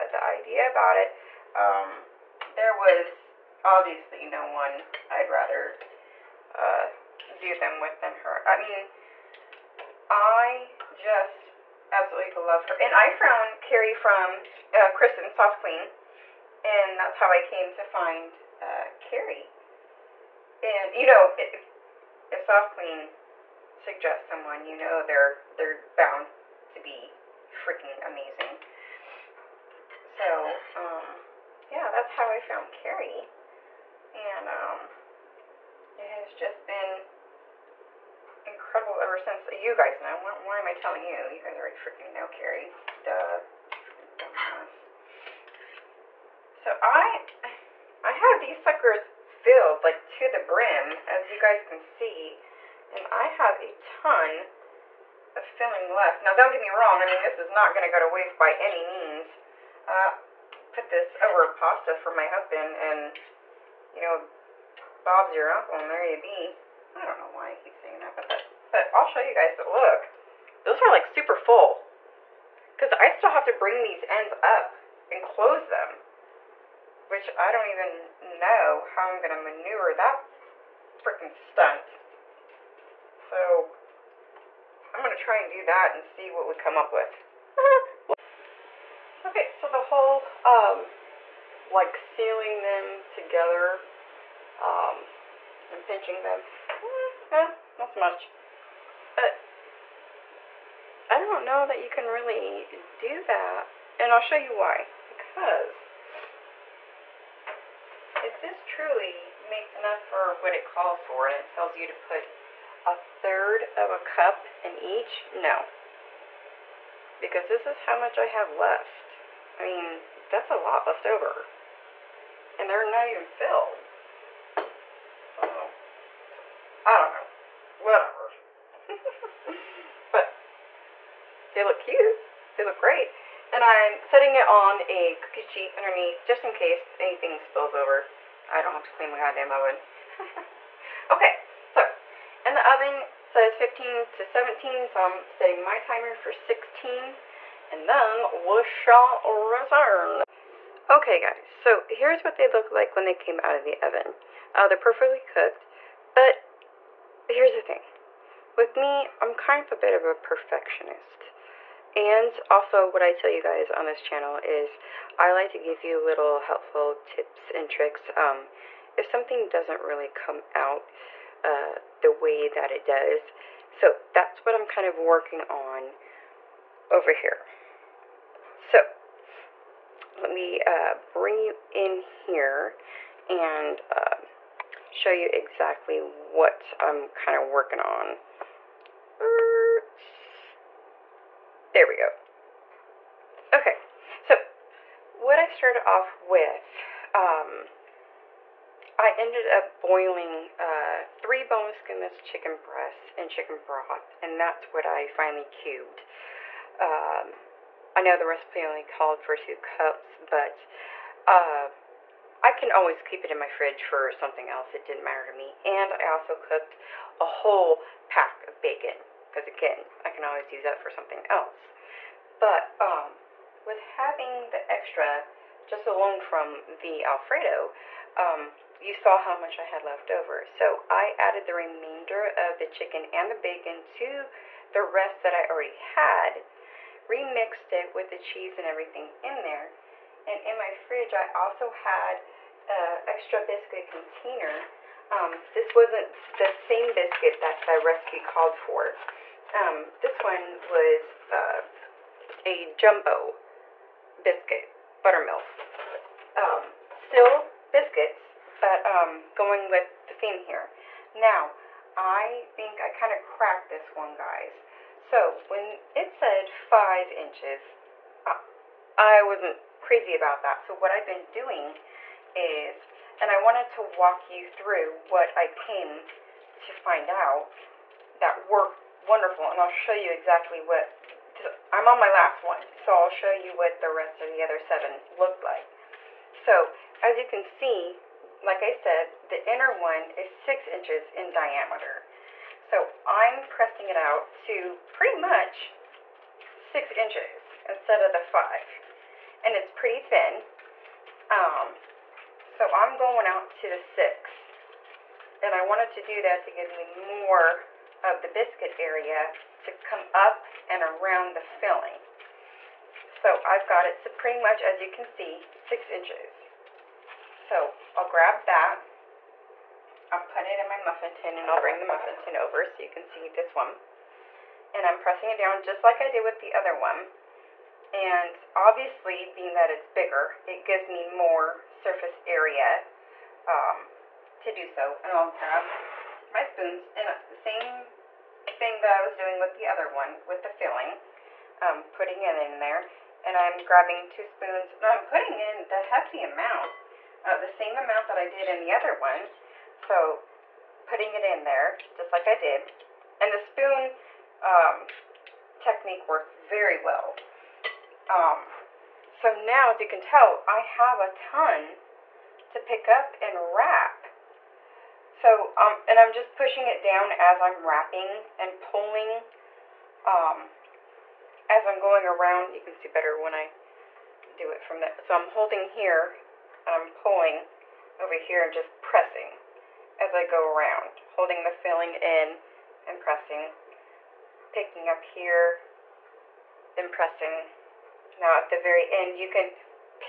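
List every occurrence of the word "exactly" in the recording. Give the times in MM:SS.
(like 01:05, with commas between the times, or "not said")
03:05, 04:40.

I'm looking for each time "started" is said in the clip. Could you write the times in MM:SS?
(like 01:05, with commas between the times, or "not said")
03:15.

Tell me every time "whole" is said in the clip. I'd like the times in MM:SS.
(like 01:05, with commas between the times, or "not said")
01:29, 03:37.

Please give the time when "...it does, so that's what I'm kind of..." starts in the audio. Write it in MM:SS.
02:52.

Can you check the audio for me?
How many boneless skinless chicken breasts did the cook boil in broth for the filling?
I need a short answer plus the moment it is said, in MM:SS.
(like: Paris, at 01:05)
3, at 03:21.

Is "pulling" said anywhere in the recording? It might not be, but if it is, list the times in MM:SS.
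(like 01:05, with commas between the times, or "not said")
06:08, 06:16.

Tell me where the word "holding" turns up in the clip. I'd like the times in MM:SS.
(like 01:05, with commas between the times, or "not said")
06:15, 06:21.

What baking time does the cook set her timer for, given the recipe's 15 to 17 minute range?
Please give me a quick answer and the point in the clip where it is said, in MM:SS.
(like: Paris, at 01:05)
16, at 02:26.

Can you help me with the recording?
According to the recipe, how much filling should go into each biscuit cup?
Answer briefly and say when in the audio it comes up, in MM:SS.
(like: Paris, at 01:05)
1/3 cup, at 01:52.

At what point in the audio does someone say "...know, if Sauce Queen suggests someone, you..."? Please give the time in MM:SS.
00:21.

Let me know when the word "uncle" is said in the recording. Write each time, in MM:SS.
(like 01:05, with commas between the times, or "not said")
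01:05.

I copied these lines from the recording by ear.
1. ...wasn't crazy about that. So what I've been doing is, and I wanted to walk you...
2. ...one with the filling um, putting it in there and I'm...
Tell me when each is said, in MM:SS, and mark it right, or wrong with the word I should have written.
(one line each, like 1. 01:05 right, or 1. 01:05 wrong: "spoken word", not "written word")
1. 04:29 right
2. 05:39 right.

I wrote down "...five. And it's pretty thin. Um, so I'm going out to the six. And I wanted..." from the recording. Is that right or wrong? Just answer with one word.
right.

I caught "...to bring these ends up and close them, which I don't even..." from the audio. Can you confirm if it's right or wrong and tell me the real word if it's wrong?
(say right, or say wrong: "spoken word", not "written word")
right.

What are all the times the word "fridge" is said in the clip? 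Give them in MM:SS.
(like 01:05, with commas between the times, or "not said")
03:33, 04:00.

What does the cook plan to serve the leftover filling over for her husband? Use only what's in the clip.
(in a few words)
pasta.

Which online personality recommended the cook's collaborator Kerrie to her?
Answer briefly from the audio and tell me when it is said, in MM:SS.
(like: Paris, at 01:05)
Kristen Sauce Queen, at 00:14.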